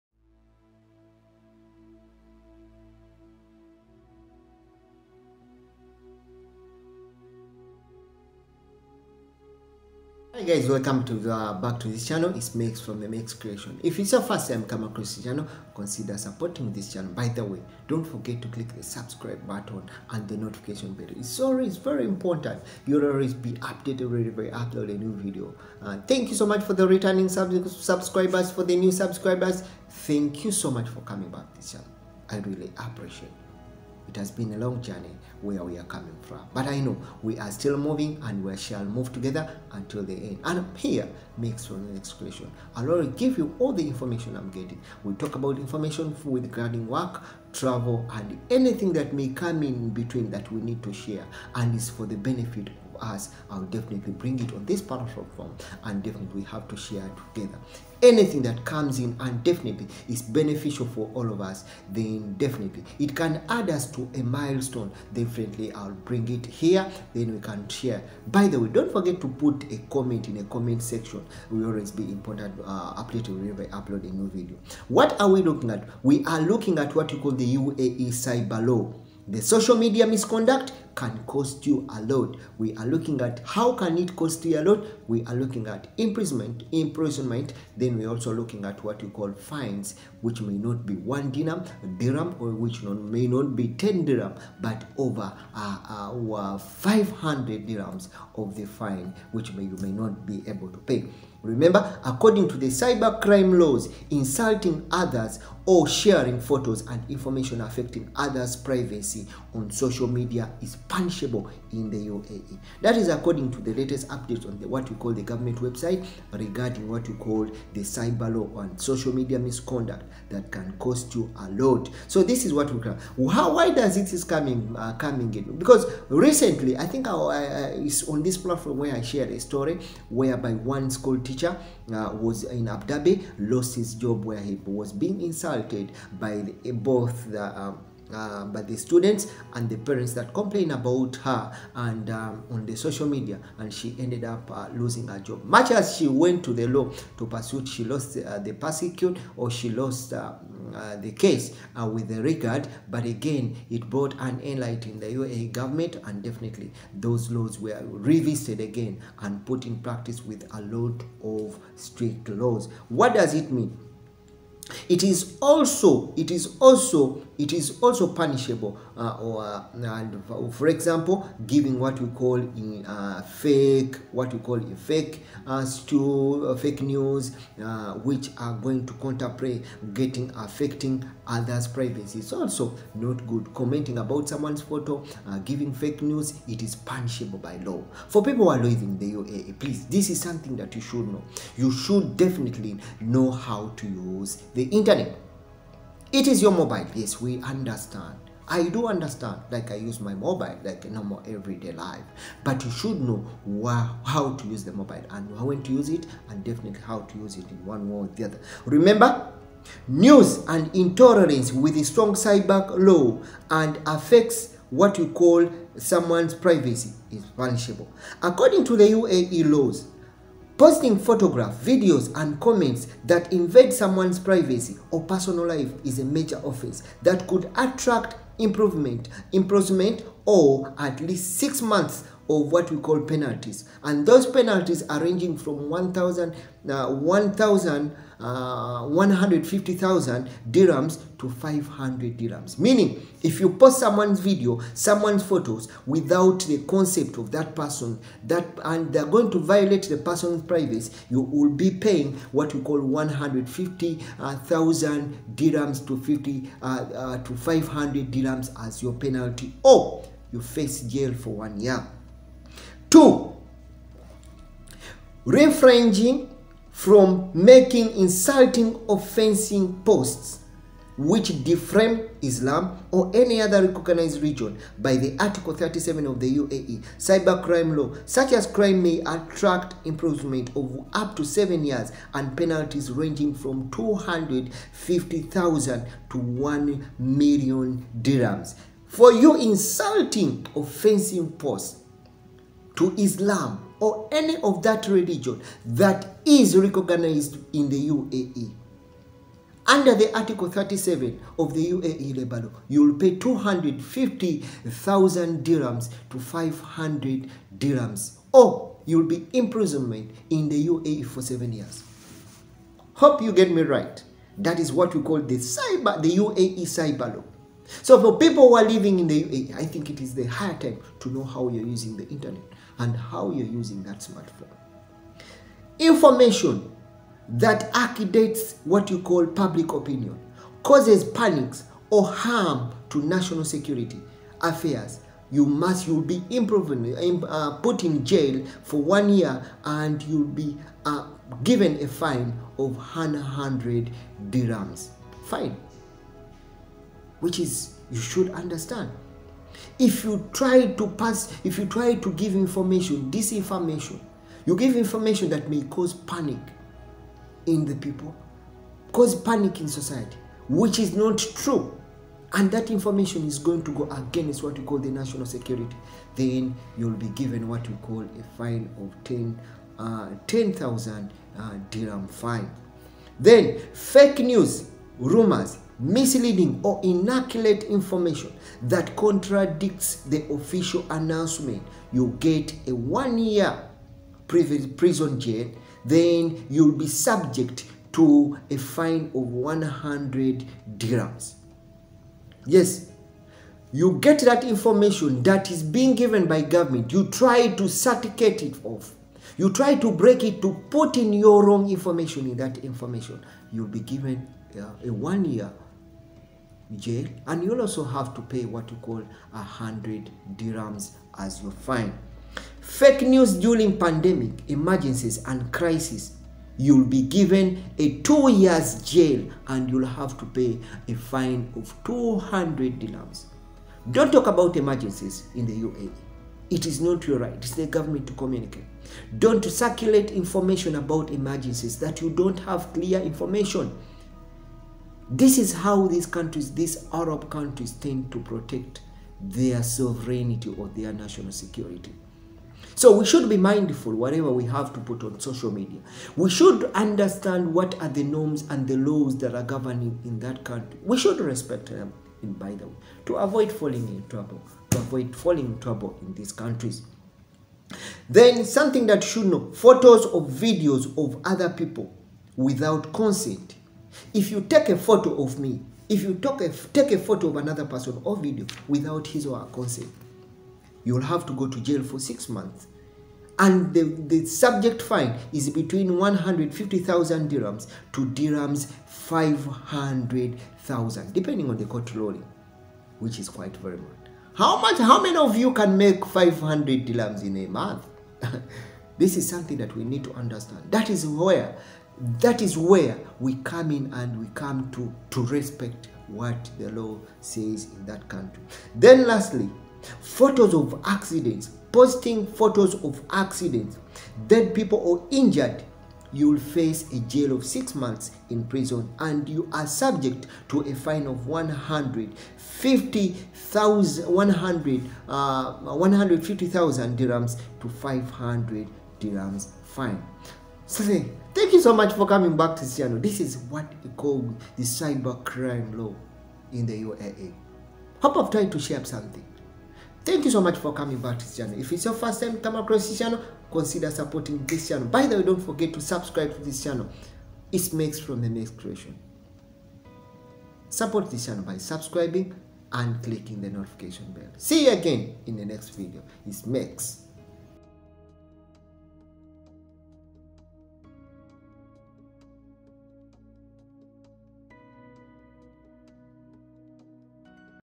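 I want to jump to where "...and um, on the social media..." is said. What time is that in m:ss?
2:21.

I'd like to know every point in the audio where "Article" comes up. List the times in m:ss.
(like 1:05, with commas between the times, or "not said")
4:35, 5:00.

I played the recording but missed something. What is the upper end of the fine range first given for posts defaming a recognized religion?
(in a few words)
1 million dirhams.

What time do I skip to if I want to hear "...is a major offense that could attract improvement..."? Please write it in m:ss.
3:45.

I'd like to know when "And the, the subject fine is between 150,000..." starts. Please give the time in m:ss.
7:53.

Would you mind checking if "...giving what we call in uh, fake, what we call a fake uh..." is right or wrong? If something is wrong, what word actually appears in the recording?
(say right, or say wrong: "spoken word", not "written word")
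right.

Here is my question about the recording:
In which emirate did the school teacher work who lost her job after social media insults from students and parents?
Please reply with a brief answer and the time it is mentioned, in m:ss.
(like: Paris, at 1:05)
Abu Dhabi, at 2:12.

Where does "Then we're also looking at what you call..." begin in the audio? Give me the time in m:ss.
1:27.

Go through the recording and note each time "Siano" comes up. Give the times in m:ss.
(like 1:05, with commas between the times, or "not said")
8:42.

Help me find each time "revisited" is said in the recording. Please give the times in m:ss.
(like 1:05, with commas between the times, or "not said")
2:37.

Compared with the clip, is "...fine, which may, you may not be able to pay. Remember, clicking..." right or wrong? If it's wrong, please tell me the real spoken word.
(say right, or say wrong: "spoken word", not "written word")
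wrong: "according", not "clicking".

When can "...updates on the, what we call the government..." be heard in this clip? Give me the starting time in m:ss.
1:54.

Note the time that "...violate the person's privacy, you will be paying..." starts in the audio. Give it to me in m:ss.
4:09.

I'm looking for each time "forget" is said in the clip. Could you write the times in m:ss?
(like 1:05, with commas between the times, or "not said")
0:18, 1:08, 8:55.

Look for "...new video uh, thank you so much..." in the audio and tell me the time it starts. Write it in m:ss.
0:24.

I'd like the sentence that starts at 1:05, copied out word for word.
Definitely, I'll bring it here, then we can share.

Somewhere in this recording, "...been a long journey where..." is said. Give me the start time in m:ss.
0:34.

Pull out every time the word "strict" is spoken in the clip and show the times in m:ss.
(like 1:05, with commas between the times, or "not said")
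2:41.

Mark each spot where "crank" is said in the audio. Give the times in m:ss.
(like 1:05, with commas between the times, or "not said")
not said.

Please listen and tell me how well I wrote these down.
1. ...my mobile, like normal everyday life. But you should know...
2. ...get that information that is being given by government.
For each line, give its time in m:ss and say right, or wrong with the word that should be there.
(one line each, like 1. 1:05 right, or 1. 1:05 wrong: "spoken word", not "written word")
1. 3:20 right
2. 6:33 right.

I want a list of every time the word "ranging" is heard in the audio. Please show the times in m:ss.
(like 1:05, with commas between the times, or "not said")
3:55, 4:42.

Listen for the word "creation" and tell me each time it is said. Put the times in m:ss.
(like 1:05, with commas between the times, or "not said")
0:13, 8:58.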